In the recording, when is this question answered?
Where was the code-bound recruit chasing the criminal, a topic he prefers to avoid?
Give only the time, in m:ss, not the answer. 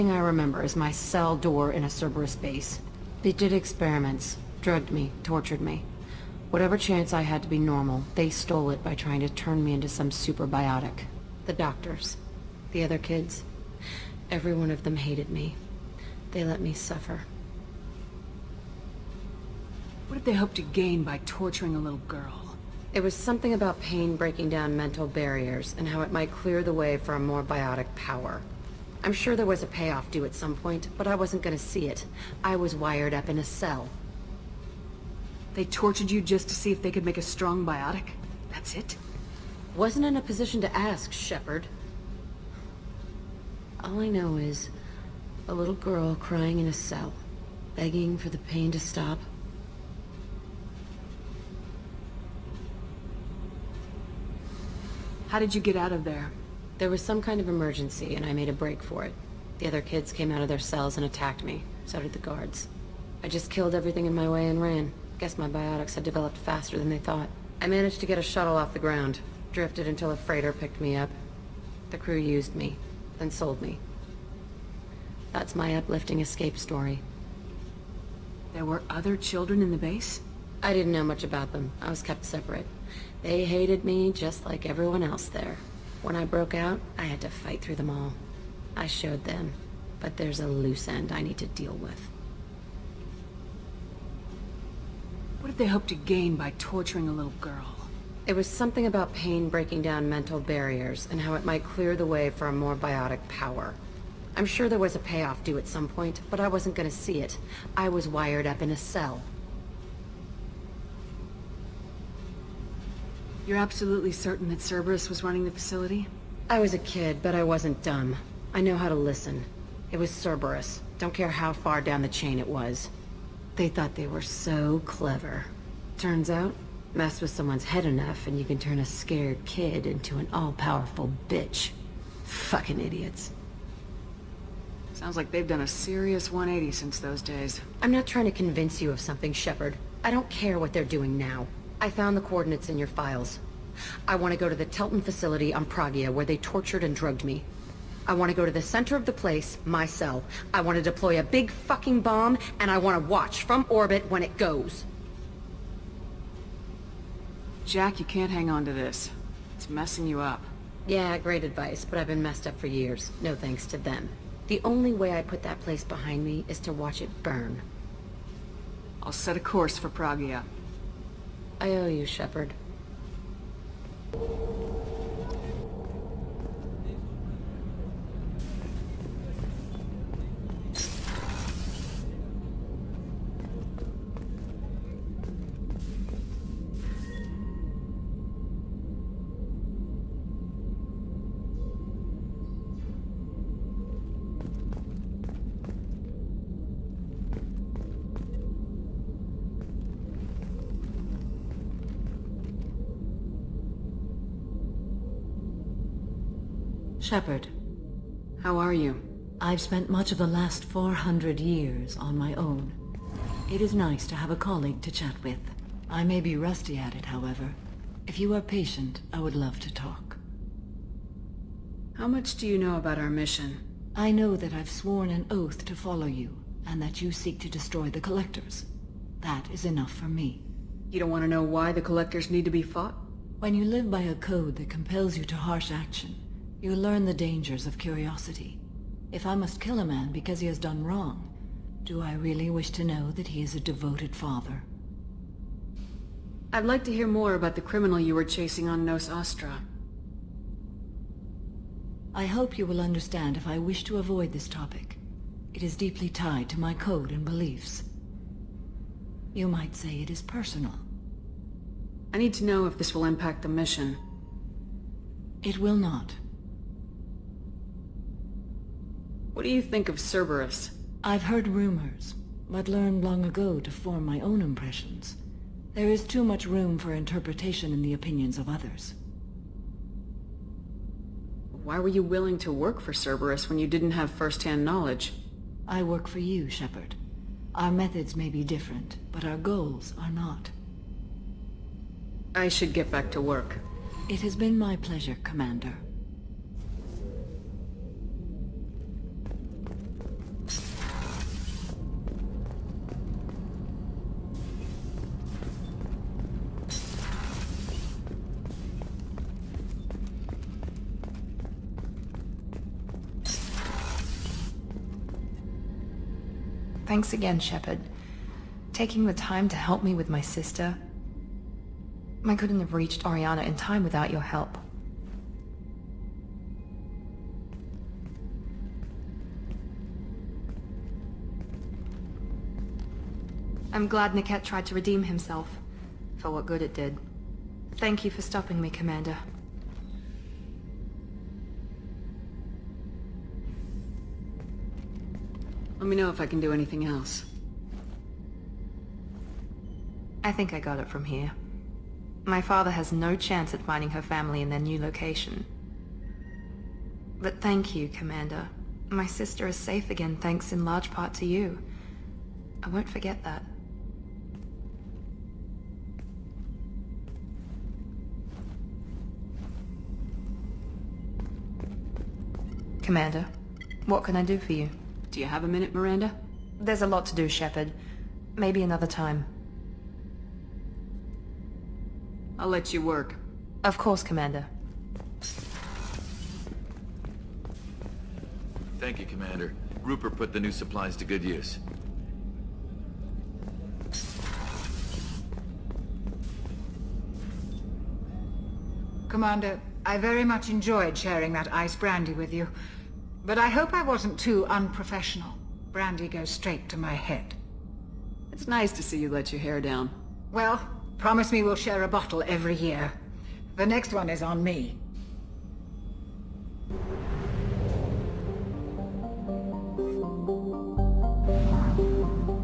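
4:08.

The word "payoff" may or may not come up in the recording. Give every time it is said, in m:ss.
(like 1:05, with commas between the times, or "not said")
0:29, 1:44.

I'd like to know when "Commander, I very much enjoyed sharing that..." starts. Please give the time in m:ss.
6:39.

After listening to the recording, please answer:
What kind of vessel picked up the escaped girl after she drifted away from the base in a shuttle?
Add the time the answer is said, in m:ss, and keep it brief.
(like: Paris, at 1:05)
A freighter, at 1:10.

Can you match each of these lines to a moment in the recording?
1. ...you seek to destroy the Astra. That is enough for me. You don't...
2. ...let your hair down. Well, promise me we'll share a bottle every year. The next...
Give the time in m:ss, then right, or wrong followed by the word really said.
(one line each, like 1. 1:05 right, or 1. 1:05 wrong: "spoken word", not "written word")
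1. 3:47 wrong: "Collectors", not "Astra"
2. 6:49 right.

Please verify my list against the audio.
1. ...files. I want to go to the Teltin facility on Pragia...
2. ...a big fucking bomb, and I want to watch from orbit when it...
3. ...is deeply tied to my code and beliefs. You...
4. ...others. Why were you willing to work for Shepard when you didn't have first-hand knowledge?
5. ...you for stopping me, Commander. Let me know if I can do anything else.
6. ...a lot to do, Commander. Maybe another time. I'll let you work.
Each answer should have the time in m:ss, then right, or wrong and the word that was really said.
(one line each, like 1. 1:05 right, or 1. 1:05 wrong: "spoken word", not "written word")
1. 2:22 right
2. 2:31 right
3. 4:15 right
4. 4:38 wrong: "Cerberus", not "Shepard"
5. 5:38 right
6. 6:16 wrong: "Shepard", not "Commander".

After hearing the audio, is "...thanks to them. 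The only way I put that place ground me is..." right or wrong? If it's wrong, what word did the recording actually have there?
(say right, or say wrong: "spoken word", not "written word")
wrong: "behind", not "ground".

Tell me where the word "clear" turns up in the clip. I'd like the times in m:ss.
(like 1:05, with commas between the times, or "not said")
0:26, 1:41.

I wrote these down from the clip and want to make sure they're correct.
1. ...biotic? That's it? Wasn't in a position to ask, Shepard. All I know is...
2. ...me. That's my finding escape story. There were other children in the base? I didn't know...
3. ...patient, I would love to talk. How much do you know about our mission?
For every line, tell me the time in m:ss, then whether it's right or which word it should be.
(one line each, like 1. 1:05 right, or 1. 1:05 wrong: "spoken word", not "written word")
1. 0:37 right
2. 1:13 wrong: "uplifting", not "finding"
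3. 3:38 right.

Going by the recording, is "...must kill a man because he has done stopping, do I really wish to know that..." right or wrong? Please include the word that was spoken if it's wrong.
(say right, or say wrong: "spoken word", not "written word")
wrong: "wrong", not "stopping".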